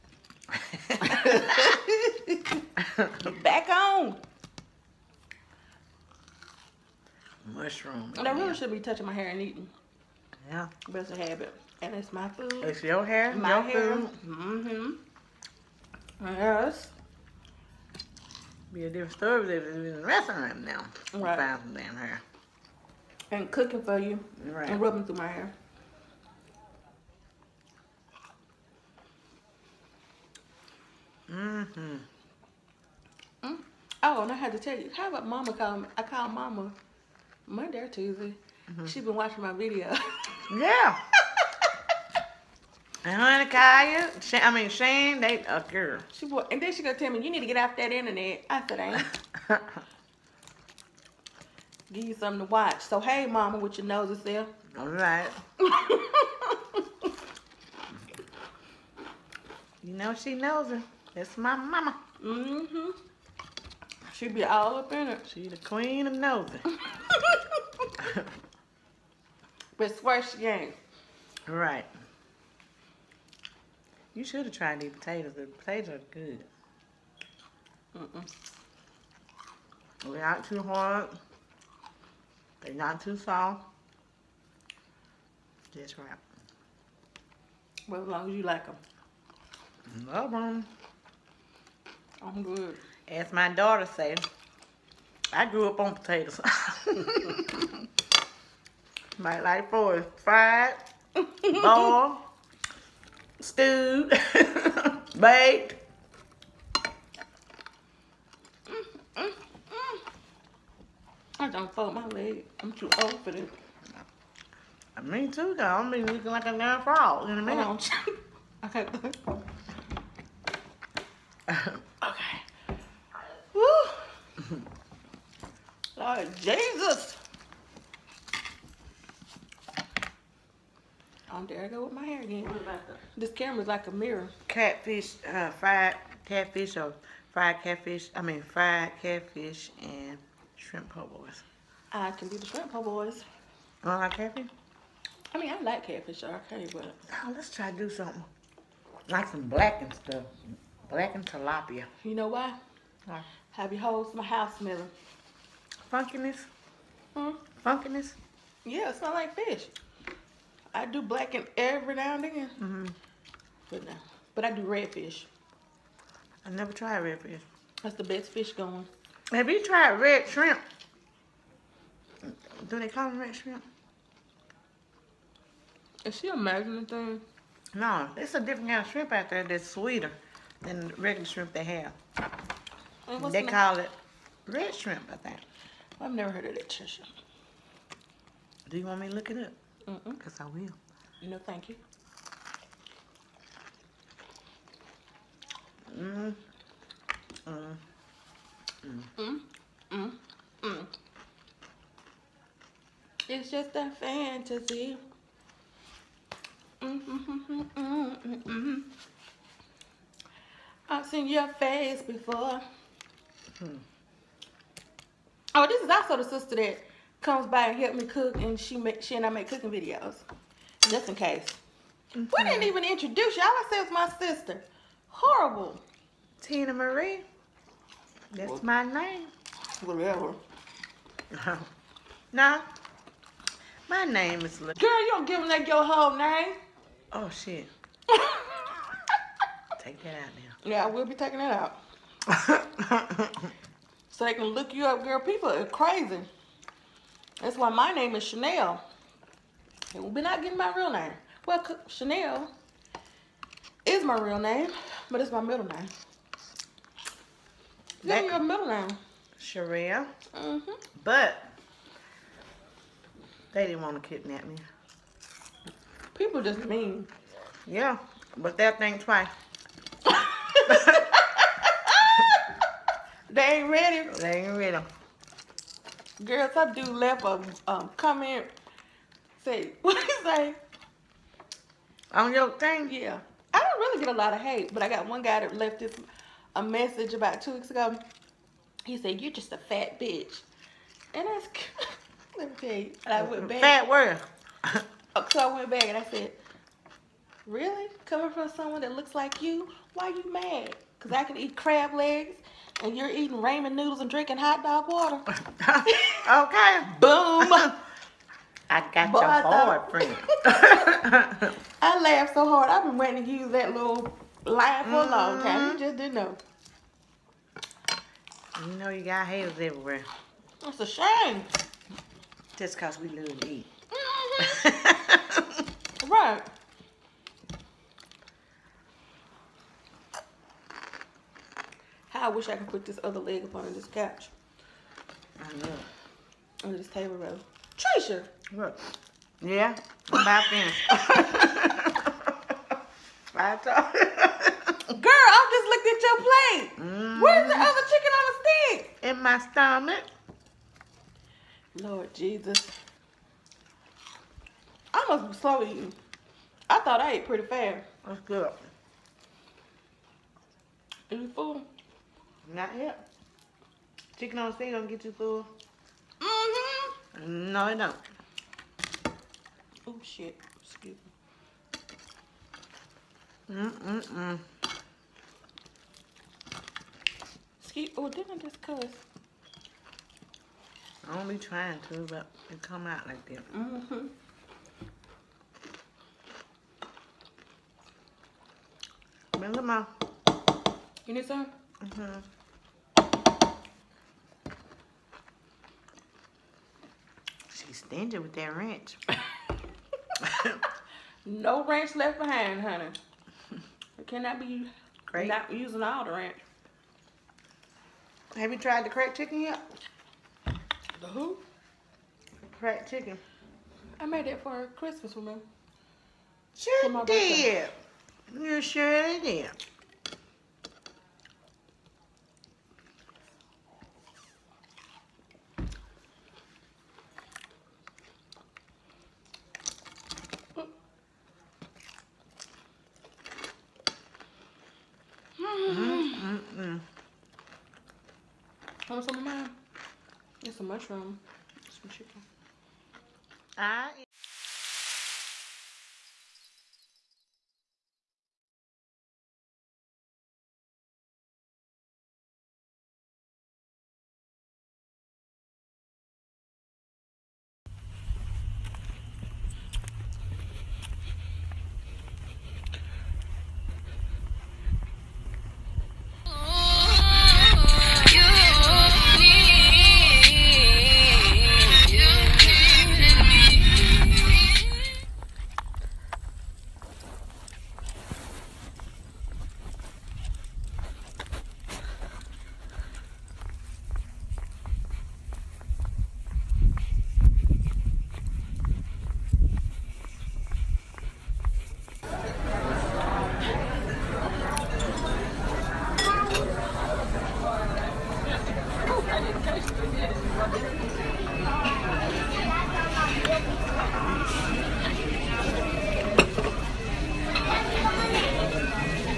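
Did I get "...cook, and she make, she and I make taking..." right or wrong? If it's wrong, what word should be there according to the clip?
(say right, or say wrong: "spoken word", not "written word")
wrong: "cooking", not "taking".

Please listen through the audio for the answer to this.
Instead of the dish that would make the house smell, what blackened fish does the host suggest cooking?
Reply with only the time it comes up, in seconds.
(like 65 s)
151 s.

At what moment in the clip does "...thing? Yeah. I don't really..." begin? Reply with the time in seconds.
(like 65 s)
282 s.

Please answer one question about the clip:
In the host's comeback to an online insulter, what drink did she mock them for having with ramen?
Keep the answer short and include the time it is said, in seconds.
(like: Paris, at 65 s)
hot dog water, at 304 s.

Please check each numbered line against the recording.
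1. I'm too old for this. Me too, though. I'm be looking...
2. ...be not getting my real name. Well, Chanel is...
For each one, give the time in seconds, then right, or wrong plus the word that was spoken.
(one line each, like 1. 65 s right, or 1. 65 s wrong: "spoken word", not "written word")
1. 112 s right
2. 250 s right.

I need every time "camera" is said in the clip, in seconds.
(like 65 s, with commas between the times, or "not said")
133 s.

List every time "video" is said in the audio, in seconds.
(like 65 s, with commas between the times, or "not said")
39 s, 219 s.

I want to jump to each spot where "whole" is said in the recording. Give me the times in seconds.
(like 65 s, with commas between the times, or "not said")
153 s, 235 s.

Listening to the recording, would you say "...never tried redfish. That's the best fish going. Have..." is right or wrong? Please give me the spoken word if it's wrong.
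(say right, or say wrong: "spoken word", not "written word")
right.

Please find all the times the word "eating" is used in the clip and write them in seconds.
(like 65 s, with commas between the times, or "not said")
9 s, 303 s, 355 s.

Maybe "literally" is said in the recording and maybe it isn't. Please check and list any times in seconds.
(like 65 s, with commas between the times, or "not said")
323 s.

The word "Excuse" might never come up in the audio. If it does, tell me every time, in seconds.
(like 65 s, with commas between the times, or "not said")
370 s, 377 s.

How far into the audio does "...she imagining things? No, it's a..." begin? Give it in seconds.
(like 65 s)
176 s.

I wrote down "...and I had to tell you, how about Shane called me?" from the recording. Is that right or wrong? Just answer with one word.
wrong.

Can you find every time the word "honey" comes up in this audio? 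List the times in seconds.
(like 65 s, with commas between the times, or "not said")
43 s, 402 s.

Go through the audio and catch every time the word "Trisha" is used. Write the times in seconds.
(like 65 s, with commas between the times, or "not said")
186 s, 337 s.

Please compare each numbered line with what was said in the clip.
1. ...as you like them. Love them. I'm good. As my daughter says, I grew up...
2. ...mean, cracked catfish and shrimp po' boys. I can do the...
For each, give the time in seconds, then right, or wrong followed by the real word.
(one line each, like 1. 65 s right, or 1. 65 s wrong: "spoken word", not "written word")
1. 88 s right
2. 138 s wrong: "fried", not "cracked".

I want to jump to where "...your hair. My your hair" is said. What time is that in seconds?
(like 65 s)
12 s.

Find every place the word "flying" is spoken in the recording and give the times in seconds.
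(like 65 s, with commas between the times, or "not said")
not said.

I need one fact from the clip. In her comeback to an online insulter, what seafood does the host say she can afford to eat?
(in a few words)
crab legs.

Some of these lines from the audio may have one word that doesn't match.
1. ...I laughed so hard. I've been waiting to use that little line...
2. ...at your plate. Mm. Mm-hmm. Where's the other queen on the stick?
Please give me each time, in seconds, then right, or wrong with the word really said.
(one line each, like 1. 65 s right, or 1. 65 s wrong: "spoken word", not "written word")
1. 311 s right
2. 345 s wrong: "chicken", not "queen".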